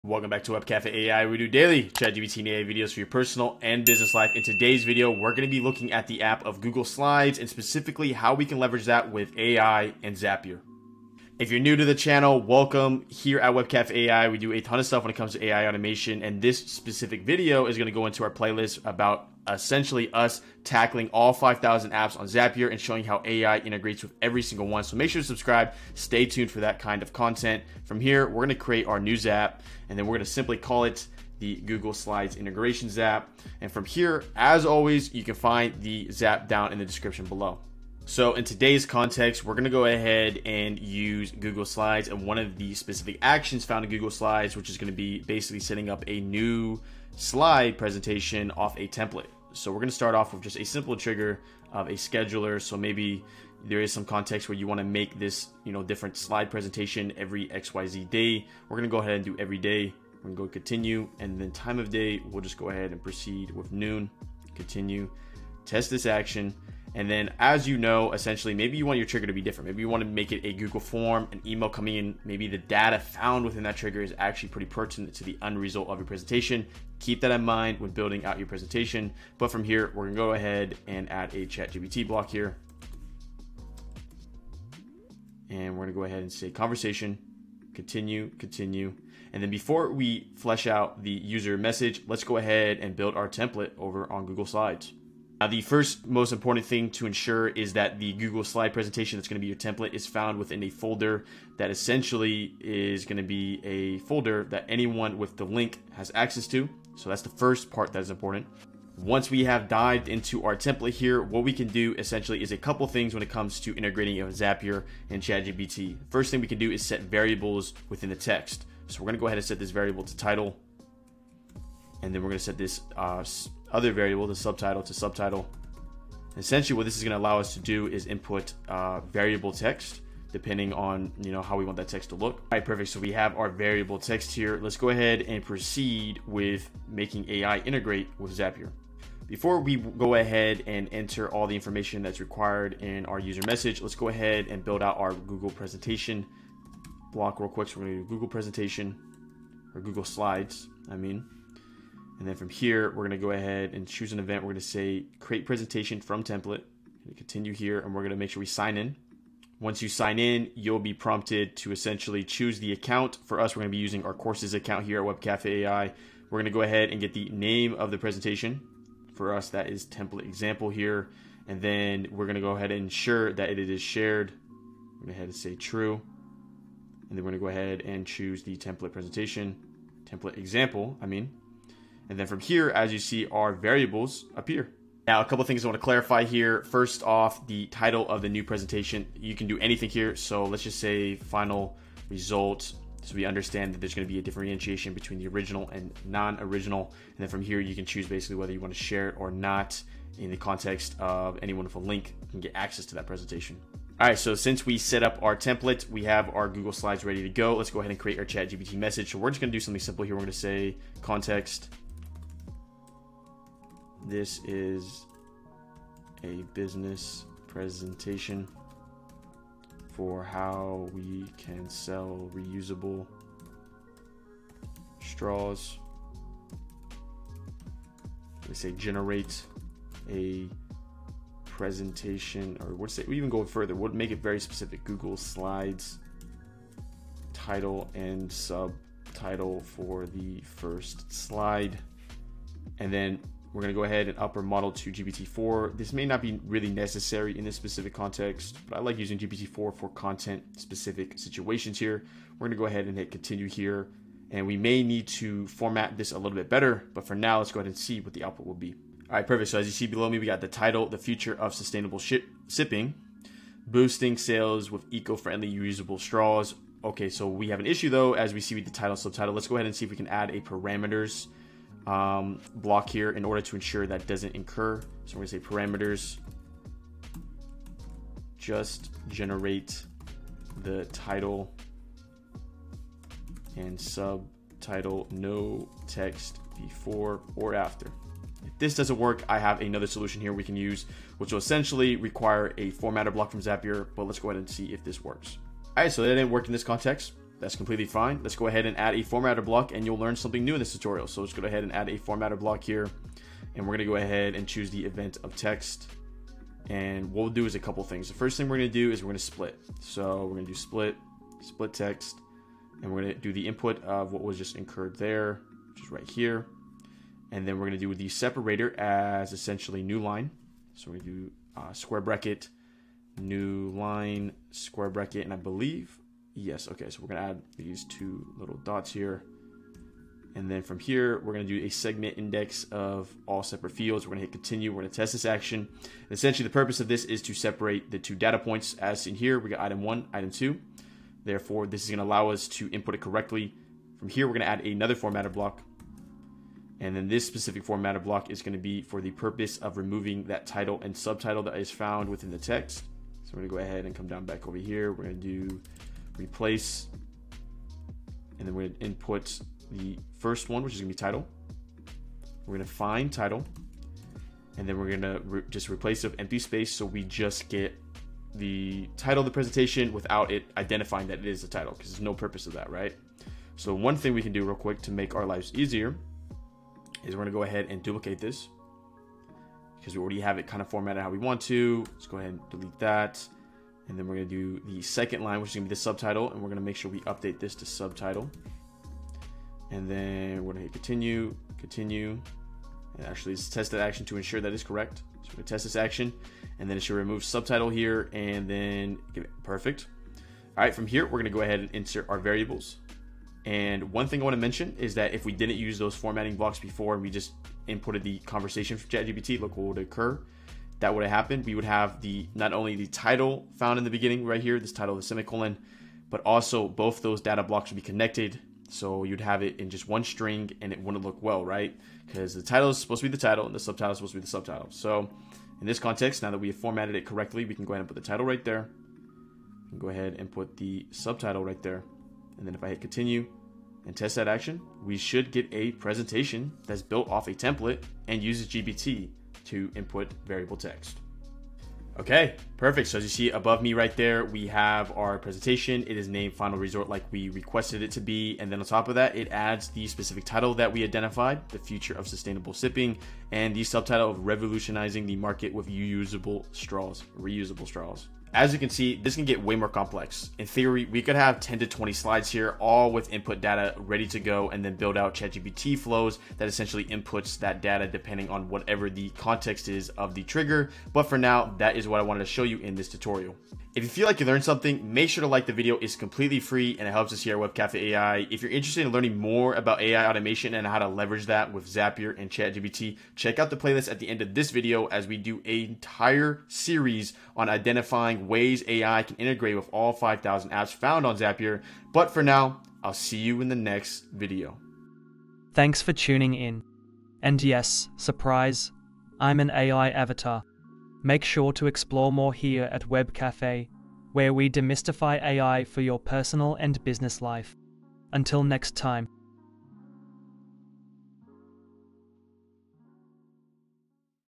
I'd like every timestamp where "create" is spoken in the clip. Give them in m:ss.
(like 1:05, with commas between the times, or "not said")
0:28, 2:35, 3:27.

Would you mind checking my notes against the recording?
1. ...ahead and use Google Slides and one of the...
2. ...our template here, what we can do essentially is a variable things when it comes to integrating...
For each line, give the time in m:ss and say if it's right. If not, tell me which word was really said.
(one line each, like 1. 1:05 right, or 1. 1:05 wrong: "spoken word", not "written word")
1. 0:39 right
2. 1:50 wrong: "couple", not "variable".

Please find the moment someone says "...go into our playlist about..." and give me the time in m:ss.
0:17.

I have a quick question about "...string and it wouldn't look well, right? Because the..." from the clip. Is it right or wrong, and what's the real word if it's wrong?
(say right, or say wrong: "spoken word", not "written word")
right.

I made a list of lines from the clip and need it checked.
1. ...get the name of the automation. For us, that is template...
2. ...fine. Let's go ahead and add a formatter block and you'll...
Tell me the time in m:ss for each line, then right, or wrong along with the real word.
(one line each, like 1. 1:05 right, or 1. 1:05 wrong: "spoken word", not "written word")
1. 2:47 wrong: "presentation", not "automation"
2. 4:57 right.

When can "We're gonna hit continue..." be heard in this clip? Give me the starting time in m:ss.
5:34.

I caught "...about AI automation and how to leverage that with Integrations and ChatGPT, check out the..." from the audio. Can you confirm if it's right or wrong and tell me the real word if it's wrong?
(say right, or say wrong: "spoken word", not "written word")
wrong: "Zapier", not "Integrations".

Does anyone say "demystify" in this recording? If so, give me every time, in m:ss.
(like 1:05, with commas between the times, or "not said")
8:24.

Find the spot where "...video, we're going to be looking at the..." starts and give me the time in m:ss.
0:04.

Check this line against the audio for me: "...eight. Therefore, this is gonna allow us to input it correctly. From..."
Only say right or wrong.
wrong.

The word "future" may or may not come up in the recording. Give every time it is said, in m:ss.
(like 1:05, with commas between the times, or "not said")
4:20, 7:31.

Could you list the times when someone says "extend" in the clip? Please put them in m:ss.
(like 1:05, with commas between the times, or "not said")
not said.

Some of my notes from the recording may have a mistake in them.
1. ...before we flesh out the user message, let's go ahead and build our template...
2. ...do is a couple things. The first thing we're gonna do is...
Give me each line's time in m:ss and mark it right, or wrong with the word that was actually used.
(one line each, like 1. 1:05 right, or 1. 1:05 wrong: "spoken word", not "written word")
1. 1:29 right
2. 5:07 right.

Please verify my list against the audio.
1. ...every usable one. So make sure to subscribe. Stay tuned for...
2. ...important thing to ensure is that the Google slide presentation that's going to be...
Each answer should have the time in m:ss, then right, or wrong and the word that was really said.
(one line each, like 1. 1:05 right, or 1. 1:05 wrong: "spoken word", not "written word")
1. 0:24 wrong: "single", not "usable"
2. 1:36 right.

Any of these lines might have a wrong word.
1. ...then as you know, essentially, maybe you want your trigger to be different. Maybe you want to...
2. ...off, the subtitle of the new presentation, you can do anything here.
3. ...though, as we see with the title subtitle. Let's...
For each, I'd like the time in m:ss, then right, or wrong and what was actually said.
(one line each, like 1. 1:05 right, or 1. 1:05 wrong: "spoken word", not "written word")
1. 1:07 right
2. 3:07 wrong: "title", not "subtitle"
3. 4:27 right.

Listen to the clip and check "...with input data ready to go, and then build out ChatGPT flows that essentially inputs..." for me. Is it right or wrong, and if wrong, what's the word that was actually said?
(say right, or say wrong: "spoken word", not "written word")
right.